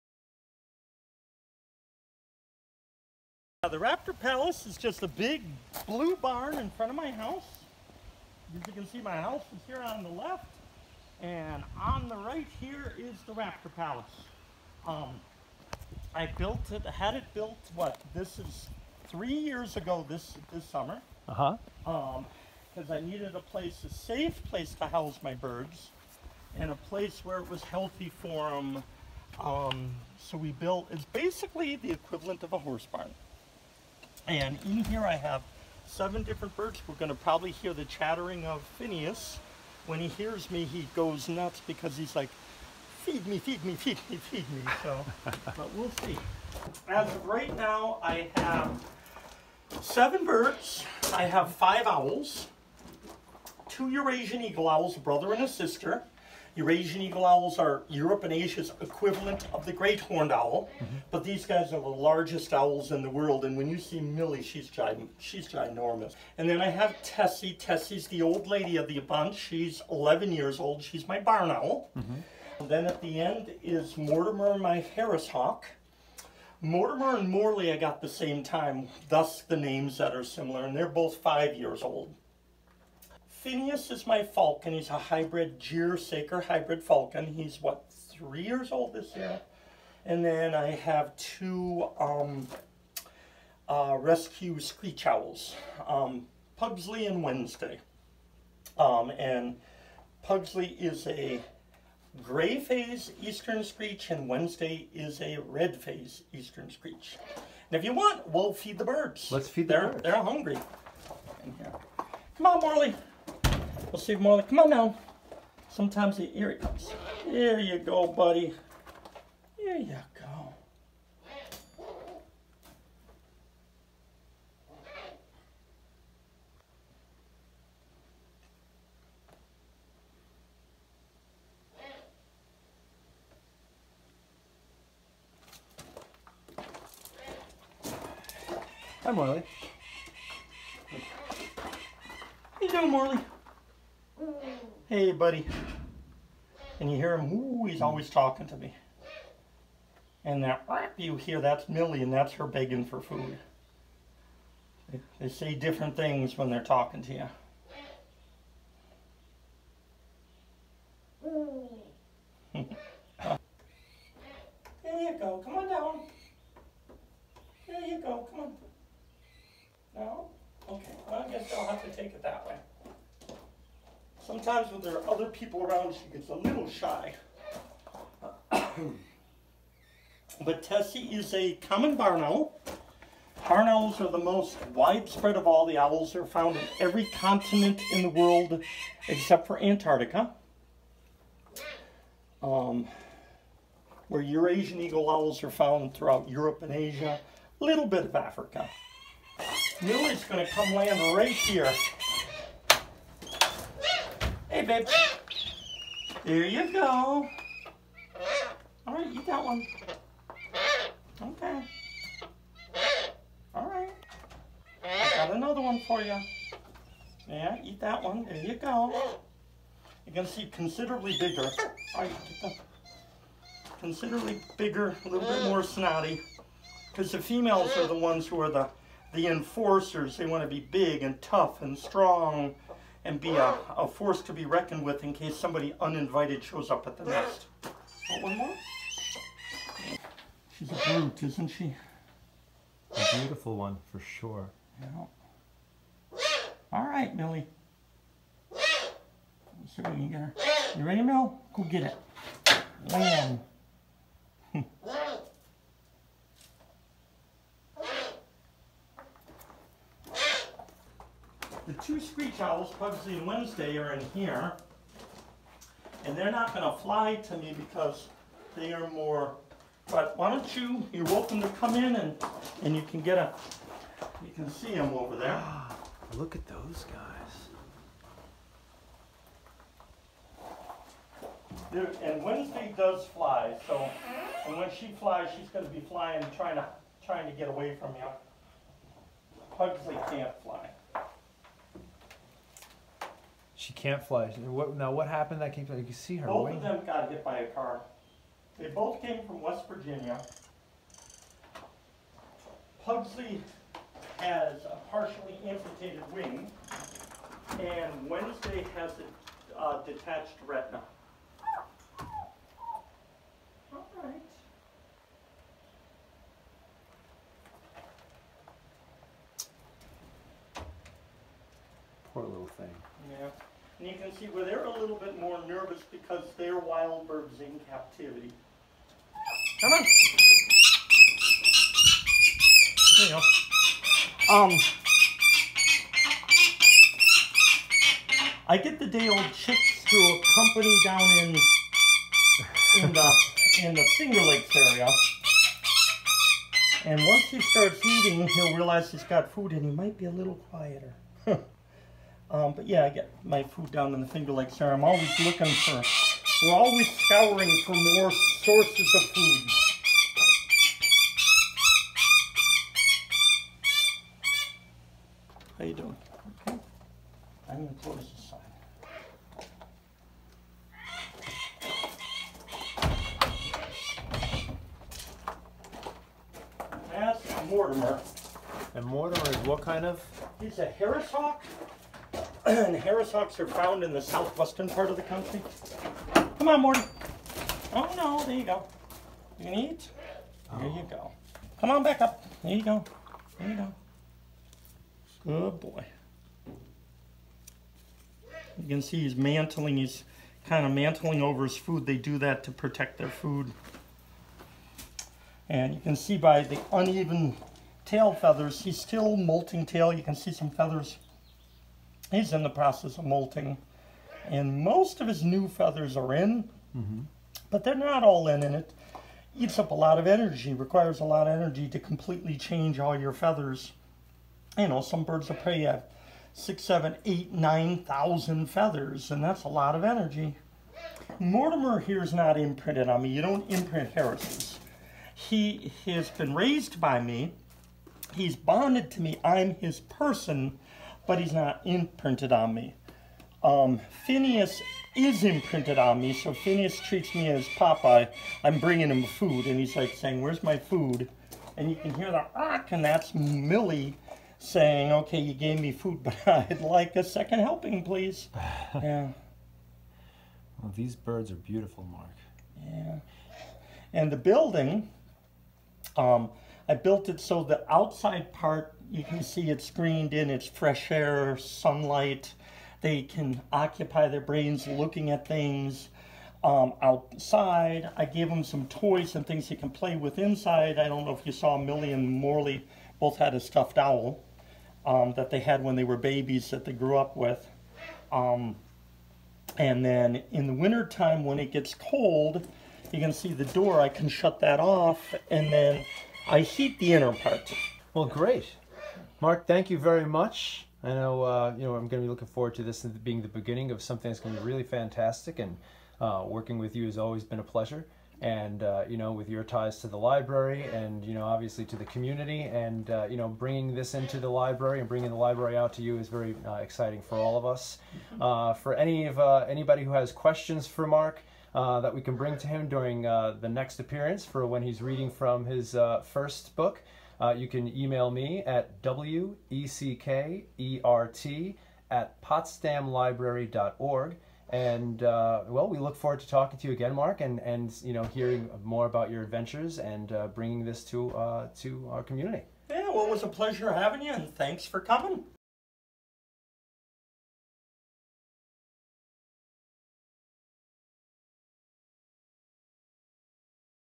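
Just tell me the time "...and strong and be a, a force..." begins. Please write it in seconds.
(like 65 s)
231 s.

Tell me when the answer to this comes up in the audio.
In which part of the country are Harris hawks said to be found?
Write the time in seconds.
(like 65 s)
384 s.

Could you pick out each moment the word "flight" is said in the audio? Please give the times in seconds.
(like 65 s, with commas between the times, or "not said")
not said.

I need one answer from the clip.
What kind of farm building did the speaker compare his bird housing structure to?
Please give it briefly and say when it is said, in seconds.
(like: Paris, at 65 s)
horse barn, at 32 s.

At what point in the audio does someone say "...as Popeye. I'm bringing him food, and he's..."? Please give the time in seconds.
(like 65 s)
447 s.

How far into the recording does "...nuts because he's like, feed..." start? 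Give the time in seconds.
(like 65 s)
41 s.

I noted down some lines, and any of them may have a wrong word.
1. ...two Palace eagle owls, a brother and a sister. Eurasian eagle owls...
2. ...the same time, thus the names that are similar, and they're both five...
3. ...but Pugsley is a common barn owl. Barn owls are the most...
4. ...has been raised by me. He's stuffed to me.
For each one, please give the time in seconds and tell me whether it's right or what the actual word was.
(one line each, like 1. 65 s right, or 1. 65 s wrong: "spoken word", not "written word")
1. 53 s wrong: "Eurasian", not "Palace"
2. 78 s right
3. 178 s wrong: "Tessie", not "Pugsley"
4. 435 s wrong: "bonded", not "stuffed".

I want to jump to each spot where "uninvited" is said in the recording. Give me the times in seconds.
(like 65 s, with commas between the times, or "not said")
235 s.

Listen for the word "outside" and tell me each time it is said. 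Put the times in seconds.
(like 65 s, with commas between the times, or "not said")
467 s, 476 s.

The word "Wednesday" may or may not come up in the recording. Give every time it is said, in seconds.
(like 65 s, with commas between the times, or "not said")
97 s, 104 s, 263 s, 282 s, 308 s.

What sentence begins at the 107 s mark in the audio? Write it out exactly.
And if you want, we'll feed the birds.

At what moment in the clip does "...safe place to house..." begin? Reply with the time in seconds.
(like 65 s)
23 s.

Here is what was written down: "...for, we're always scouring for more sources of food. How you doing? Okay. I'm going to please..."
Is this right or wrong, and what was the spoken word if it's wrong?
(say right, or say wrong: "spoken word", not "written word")
wrong: "close", not "please".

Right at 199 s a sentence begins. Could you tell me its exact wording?
New is going to come land right here.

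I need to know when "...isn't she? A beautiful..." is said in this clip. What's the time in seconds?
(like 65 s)
241 s.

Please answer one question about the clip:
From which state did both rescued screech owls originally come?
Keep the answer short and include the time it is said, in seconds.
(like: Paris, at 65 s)
West Virginia, at 299 s.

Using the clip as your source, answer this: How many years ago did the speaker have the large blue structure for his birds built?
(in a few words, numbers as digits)
3.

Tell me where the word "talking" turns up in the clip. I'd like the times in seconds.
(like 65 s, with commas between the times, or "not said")
148 s, 156 s, 536 s.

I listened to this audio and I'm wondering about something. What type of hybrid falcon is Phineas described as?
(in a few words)
gyrsaker.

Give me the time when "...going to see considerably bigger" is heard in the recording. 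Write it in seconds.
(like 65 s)
220 s.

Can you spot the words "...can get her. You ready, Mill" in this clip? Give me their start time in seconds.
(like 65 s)
249 s.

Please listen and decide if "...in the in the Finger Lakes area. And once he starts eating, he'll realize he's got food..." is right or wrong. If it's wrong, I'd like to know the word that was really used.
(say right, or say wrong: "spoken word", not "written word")
right.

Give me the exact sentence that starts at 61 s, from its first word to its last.
but these guys are the largest owls in the world.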